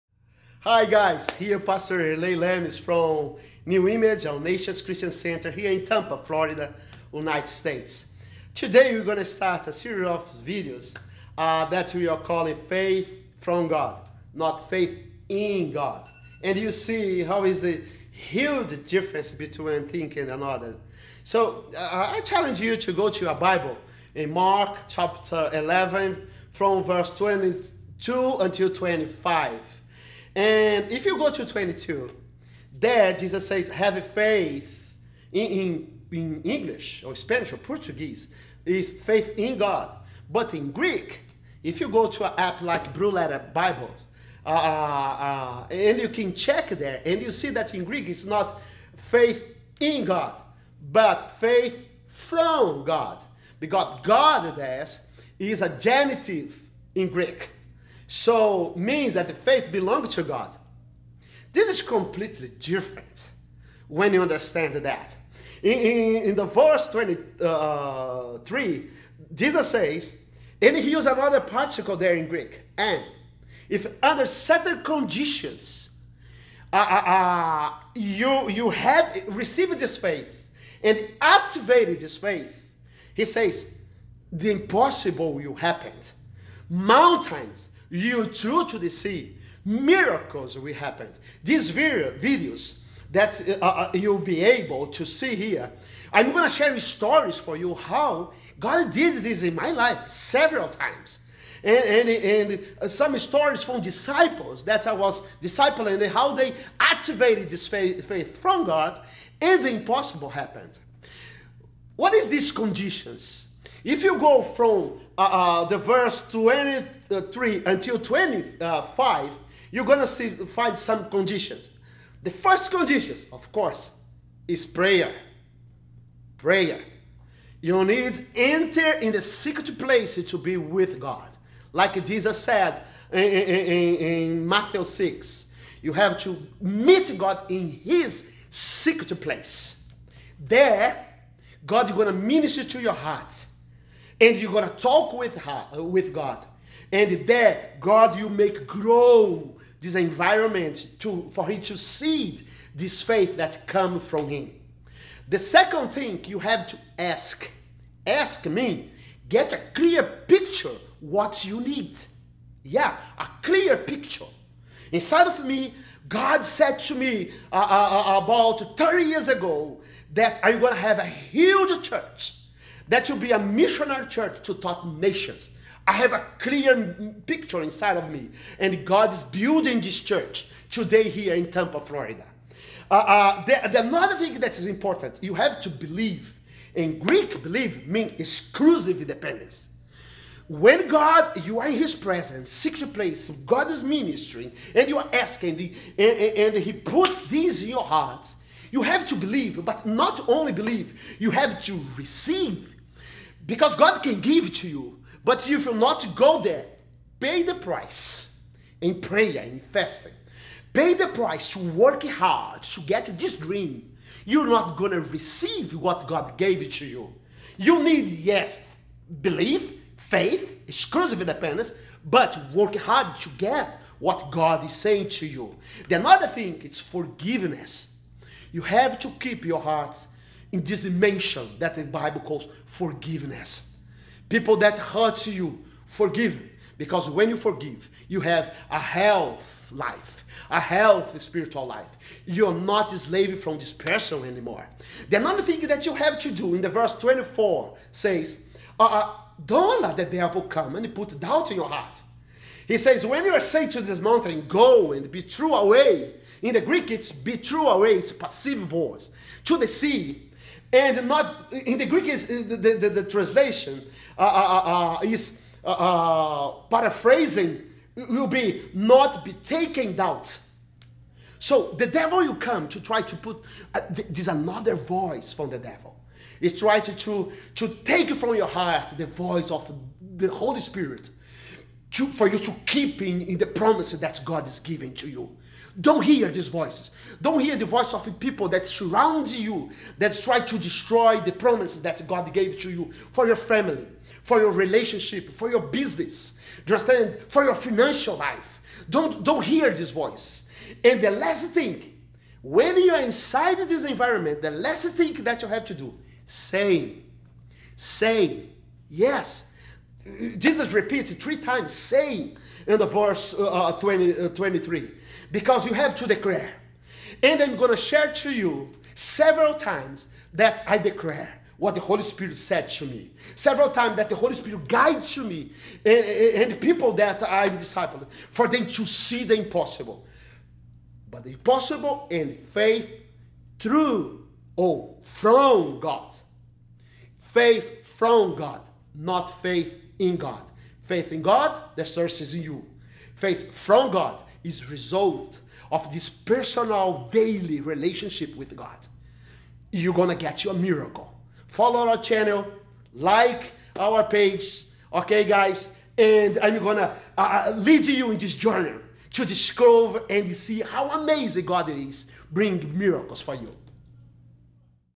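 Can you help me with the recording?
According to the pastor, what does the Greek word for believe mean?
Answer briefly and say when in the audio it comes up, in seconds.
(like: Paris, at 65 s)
Exclusive dependence, at 188 s.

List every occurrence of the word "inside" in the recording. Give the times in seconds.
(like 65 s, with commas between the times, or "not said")
164 s, 177 s, 303 s.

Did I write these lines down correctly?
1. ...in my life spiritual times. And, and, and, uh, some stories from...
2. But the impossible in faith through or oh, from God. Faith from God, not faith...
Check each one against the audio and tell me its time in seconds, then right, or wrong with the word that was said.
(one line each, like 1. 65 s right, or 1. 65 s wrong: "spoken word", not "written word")
1. 99 s wrong: "several", not "spiritual"
2. 331 s right.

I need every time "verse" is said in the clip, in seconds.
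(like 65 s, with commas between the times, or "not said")
26 s, 66 s, 115 s, 246 s, 312 s.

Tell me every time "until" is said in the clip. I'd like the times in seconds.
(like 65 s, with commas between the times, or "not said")
28 s, 117 s.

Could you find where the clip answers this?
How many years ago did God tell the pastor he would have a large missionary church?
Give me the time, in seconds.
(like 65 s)
168 s.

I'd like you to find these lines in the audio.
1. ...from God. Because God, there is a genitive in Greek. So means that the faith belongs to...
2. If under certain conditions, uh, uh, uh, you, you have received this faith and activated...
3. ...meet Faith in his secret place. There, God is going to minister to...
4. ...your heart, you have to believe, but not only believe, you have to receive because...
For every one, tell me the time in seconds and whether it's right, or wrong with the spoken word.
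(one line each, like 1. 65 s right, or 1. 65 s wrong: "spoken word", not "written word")
1. 52 s right
2. 73 s right
3. 136 s wrong: "God", not "Faith"
4. 197 s right.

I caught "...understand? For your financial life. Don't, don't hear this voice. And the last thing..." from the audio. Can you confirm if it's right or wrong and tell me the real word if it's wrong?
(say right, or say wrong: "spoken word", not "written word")
right.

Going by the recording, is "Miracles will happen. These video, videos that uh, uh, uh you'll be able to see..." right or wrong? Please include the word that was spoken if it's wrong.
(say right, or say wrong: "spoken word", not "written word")
right.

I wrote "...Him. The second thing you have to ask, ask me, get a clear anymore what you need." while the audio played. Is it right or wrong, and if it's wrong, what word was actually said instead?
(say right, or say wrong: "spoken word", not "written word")
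wrong: "picture", not "anymore".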